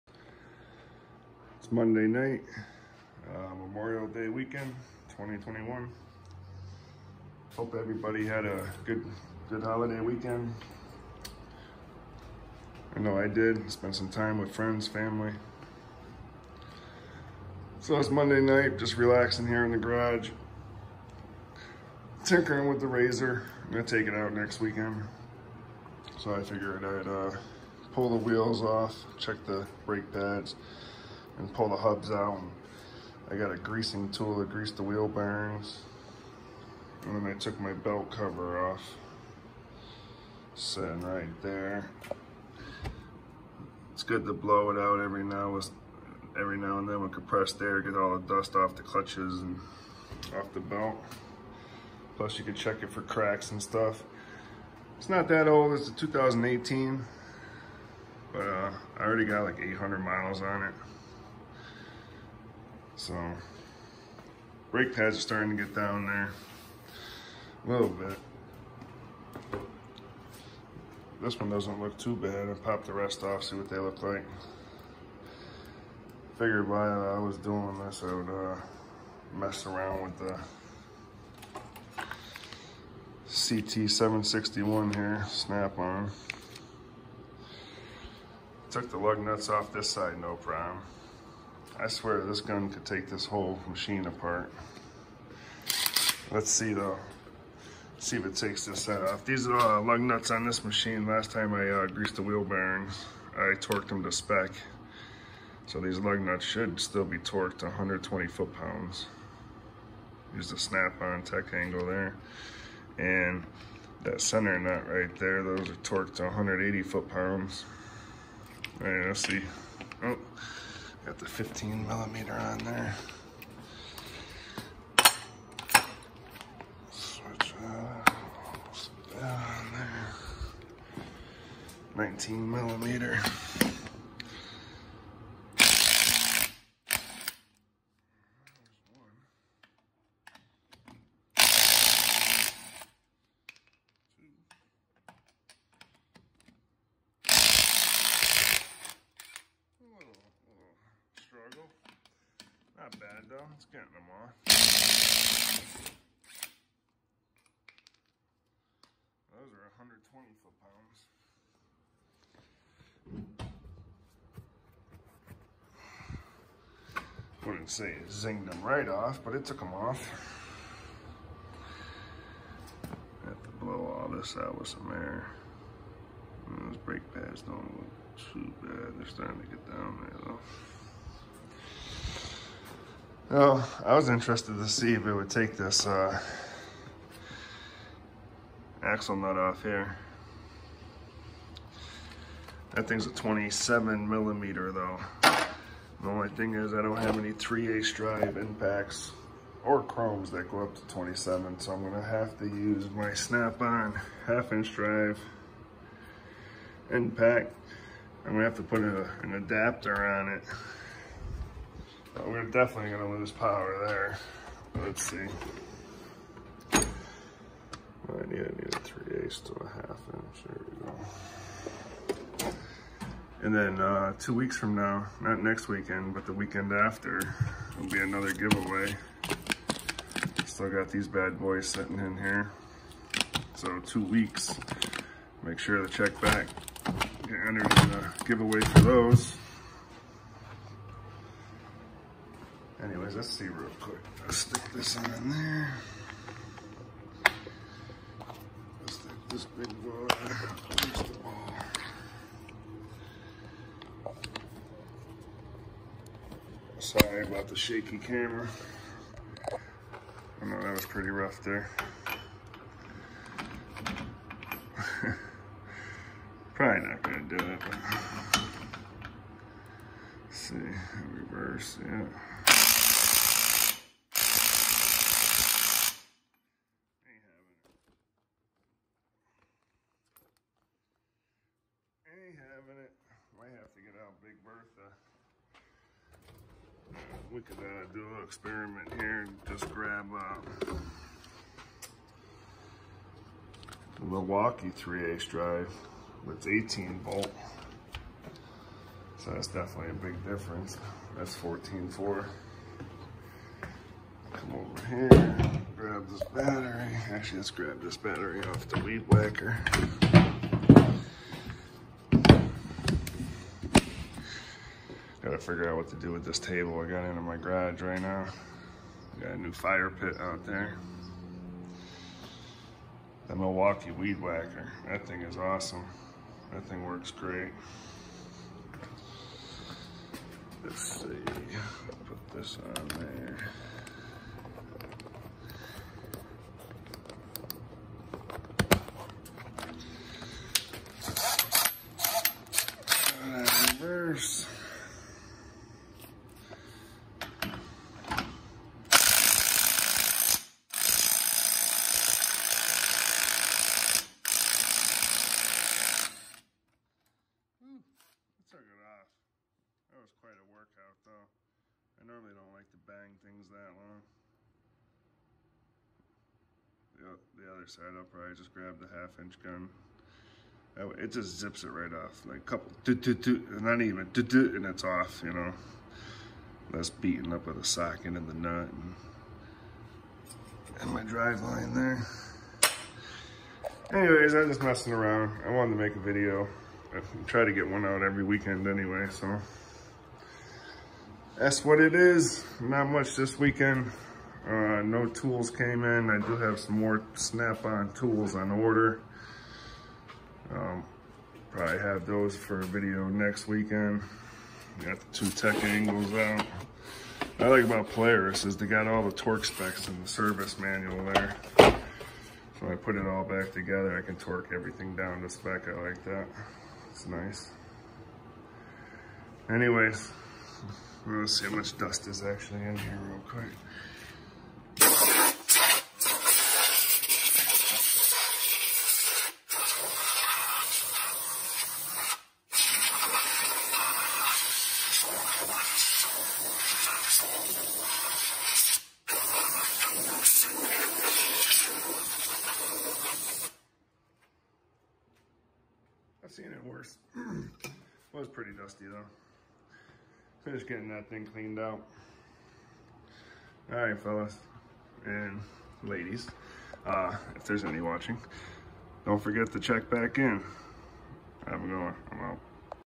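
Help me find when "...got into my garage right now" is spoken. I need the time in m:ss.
5:16.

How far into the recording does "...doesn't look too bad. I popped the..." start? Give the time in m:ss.
1:11.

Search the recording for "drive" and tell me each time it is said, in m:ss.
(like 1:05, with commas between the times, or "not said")
3:17, 3:24, 4:55, 6:21.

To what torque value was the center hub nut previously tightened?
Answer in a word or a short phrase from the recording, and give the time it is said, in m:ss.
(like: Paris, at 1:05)
180 foot-pounds, at 1:56.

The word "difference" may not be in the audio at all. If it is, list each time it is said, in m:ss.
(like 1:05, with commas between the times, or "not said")
5:00.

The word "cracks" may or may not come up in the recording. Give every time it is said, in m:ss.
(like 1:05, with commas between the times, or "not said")
0:53.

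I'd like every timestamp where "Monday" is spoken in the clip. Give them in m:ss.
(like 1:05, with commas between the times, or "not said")
0:01, 0:18.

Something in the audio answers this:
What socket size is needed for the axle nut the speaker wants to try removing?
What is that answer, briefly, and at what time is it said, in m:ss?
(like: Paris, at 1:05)
27 millimeter, at 3:13.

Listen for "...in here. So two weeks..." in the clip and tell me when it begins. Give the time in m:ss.
3:51.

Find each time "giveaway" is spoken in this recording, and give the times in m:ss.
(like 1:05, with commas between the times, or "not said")
3:48, 3:58.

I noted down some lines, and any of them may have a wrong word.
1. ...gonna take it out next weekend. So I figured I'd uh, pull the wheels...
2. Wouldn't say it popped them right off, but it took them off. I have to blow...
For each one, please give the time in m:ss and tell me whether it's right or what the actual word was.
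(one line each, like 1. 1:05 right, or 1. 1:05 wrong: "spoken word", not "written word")
1. 0:23 right
2. 2:47 wrong: "zinged", not "popped".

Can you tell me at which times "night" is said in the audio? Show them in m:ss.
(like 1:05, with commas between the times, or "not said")
0:02, 0:18.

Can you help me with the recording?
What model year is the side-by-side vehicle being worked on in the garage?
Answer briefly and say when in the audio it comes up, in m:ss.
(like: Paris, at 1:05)
2018, at 0:55.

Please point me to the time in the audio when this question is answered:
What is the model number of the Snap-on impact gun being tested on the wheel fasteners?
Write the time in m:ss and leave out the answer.
1:23.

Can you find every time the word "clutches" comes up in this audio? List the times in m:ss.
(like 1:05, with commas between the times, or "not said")
0:48.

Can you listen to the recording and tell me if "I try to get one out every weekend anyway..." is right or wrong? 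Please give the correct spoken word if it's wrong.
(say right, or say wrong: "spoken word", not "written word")
right.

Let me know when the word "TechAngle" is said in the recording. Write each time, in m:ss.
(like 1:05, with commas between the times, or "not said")
1:51, 6:45.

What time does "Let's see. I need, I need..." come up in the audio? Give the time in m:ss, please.
3:34.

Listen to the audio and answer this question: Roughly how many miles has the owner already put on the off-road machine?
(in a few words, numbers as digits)
800.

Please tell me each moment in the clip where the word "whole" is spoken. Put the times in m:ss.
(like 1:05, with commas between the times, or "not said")
1:33.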